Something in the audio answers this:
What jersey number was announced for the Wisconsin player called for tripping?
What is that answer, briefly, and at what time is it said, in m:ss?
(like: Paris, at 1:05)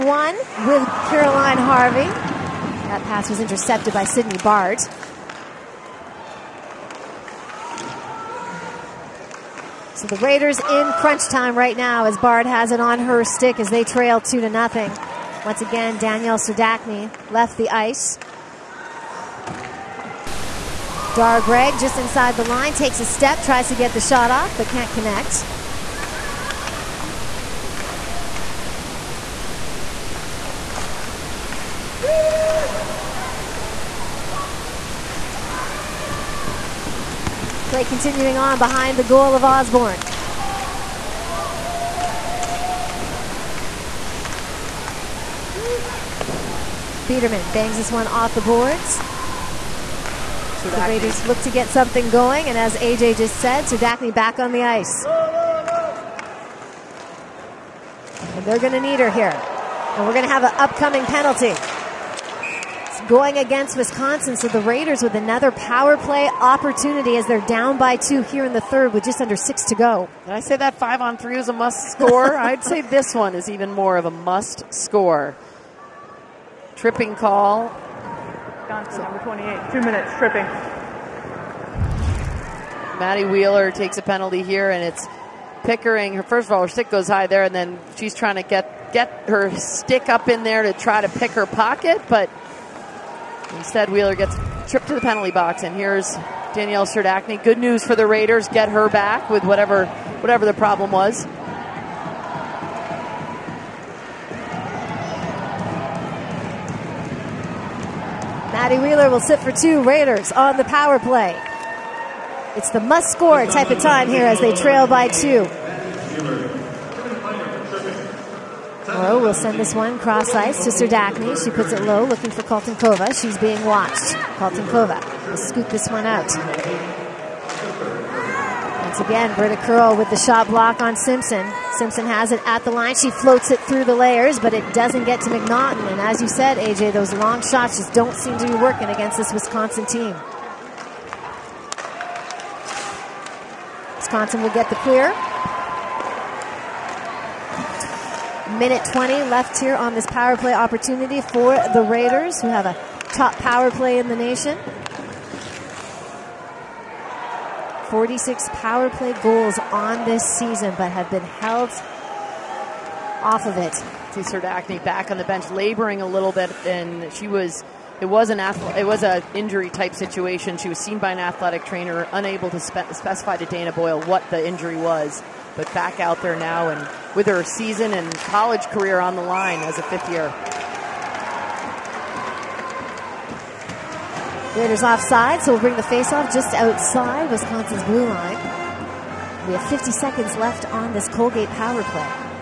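28, at 1:19.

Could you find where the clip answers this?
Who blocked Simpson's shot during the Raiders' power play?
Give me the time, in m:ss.
2:09.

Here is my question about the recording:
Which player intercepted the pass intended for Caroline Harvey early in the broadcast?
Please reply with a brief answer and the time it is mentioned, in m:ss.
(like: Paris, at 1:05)
Sydney Bard, at 0:04.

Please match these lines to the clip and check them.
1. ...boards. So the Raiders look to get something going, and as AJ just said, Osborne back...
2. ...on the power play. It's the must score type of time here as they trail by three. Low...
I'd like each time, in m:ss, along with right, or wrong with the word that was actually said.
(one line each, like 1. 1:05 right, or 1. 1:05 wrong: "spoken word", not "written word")
1. 0:48 wrong: "Serdachny", not "Osborne"
2. 1:50 wrong: "two", not "three".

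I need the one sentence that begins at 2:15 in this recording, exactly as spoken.
And as you said, AJ, those long shots just don't seem to be working against this Wisconsin team.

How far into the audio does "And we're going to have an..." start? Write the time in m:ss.
0:59.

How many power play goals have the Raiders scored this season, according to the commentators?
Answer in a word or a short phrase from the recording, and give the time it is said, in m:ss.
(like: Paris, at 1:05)
46, at 2:37.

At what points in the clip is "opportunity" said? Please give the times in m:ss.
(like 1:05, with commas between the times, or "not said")
1:06, 2:30.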